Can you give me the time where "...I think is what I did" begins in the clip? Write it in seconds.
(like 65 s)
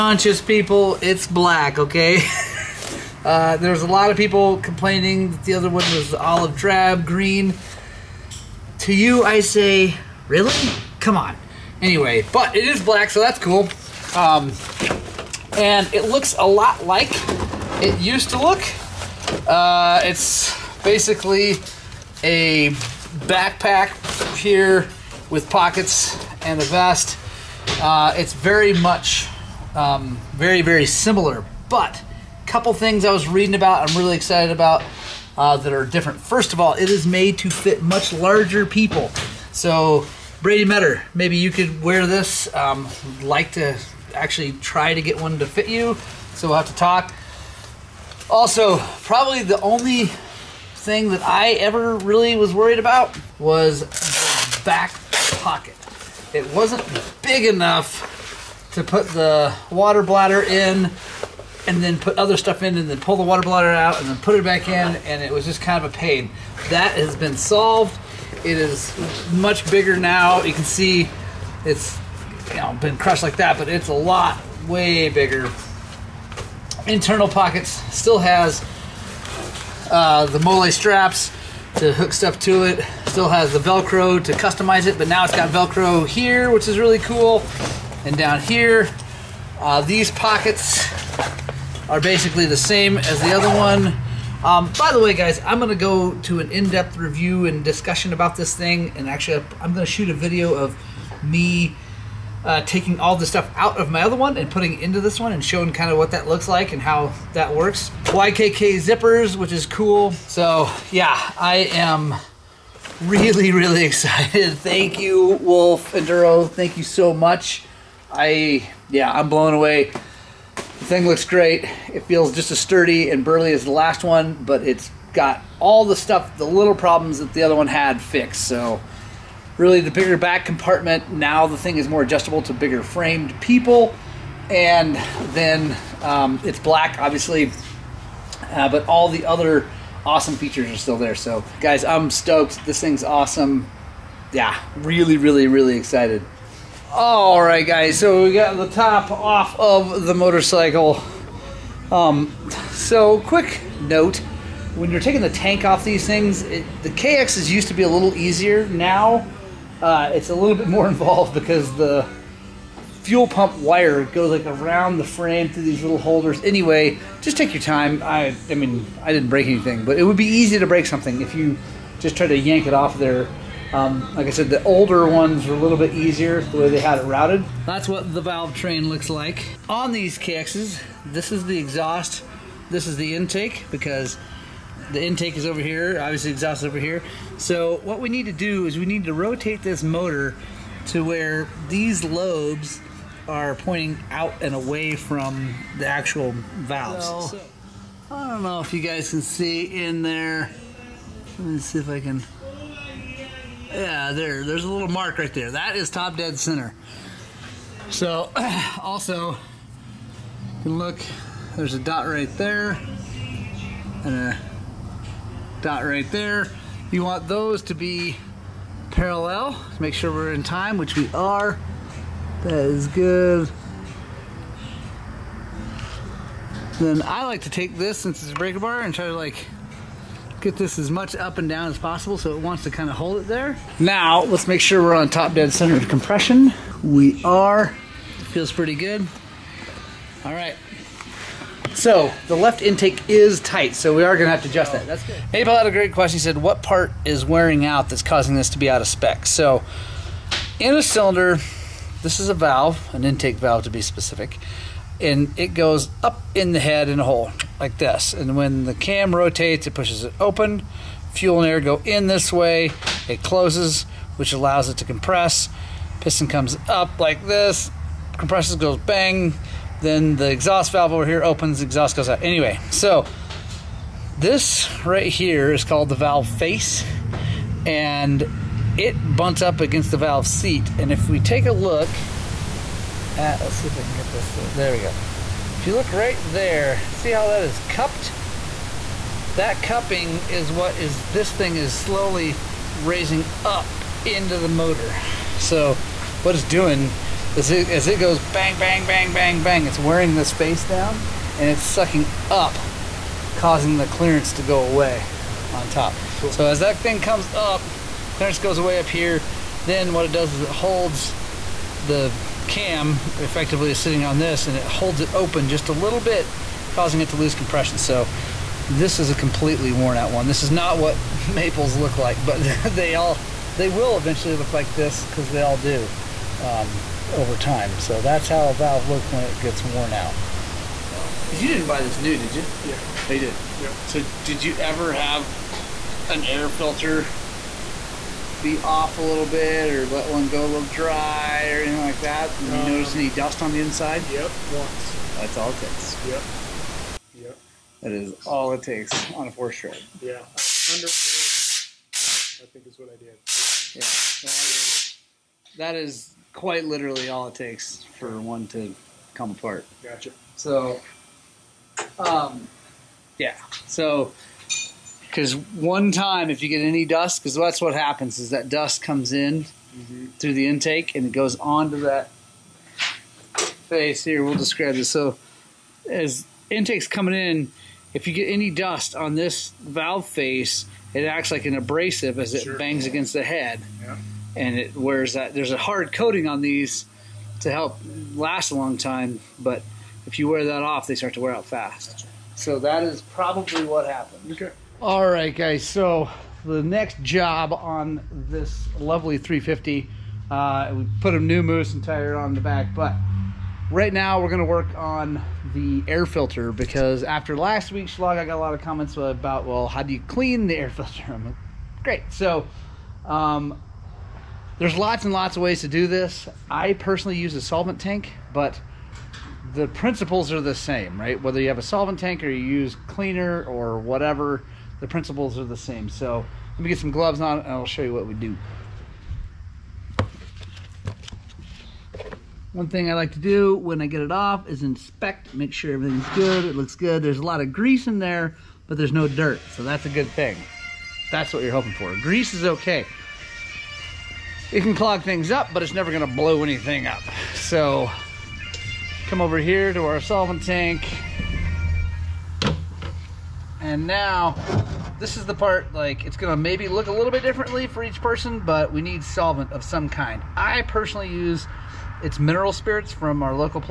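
350 s.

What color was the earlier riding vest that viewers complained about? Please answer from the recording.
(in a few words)
Olive drab.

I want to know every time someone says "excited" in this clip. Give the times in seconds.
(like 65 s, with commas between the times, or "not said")
34 s, 113 s, 145 s.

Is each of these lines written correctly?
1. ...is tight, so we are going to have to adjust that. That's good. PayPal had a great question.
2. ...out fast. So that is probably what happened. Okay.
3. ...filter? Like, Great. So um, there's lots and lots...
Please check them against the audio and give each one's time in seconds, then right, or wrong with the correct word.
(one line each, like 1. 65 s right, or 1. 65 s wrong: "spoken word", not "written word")
1. 243 s right
2. 391 s right
3. 410 s right.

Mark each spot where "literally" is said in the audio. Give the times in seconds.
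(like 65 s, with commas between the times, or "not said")
356 s.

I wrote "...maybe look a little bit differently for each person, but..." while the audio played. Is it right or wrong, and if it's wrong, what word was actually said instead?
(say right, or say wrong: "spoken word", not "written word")
right.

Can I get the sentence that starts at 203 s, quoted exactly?
Yeah, there, there's a little mark right there.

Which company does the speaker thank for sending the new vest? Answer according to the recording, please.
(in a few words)
Wolf Enduro.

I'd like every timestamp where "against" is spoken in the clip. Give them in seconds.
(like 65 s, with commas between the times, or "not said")
279 s, 382 s.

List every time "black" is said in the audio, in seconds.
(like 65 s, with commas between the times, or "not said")
1 s, 12 s, 136 s.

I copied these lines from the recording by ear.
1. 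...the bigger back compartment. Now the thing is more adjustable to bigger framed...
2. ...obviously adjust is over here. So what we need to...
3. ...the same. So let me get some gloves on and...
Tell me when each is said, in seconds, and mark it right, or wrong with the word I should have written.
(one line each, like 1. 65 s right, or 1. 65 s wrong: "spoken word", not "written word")
1. 129 s right
2. 186 s wrong: "exhaust", not "adjust"
3. 425 s right.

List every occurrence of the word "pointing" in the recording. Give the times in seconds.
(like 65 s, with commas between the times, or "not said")
193 s.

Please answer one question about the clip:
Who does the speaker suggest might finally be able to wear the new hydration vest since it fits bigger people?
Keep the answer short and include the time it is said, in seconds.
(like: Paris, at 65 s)
Brady Metter, at 40 s.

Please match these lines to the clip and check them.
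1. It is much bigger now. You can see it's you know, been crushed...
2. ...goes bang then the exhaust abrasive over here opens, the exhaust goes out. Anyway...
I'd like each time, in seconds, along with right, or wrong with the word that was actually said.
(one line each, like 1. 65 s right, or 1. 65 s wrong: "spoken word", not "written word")
1. 68 s right
2. 268 s wrong: "valve", not "abrasive".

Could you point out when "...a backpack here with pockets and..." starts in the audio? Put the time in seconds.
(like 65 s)
22 s.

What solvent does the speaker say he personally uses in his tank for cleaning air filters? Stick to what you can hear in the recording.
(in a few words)
Mineral spirits.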